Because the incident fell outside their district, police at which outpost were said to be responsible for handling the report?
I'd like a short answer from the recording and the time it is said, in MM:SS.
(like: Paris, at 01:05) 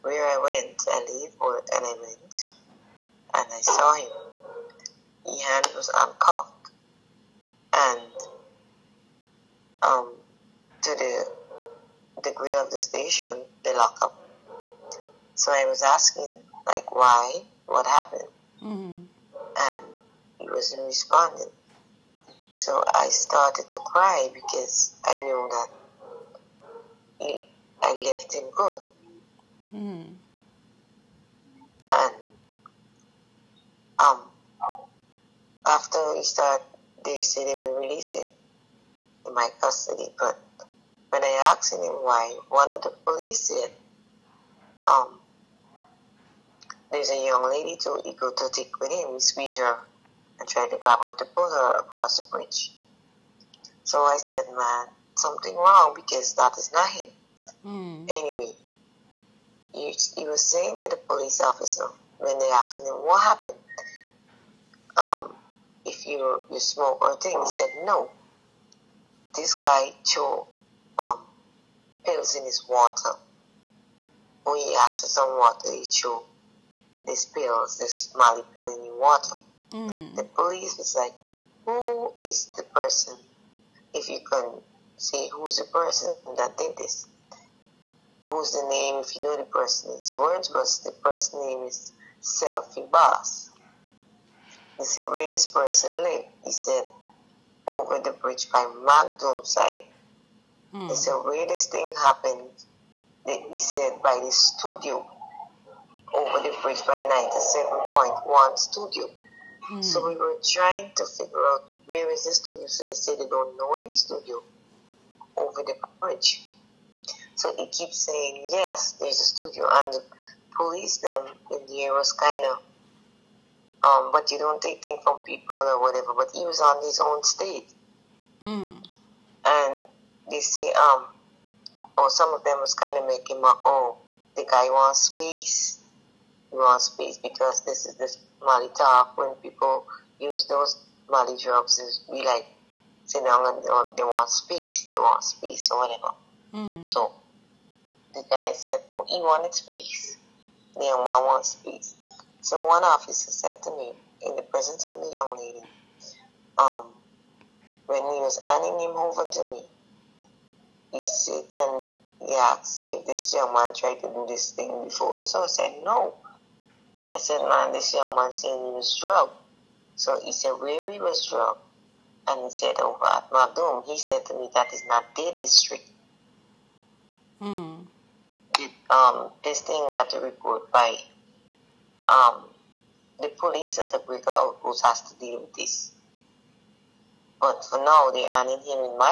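Breaker Outpost, at 03:03.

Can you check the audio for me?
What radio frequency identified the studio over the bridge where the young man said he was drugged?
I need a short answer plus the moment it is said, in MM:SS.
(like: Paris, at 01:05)
97.1, at 01:47.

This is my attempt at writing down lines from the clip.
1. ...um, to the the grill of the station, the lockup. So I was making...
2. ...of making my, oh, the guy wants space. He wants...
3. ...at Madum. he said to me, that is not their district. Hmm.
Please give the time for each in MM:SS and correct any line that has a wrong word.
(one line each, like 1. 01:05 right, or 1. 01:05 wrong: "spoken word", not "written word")
1. 00:09 wrong: "asking", not "making"
2. 02:12 right
3. 02:53 right.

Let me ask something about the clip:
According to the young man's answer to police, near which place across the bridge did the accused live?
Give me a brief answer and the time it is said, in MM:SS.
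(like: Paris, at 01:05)
Magnum side, at 01:38.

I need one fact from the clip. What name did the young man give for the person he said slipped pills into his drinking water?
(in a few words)
Selfie Boss.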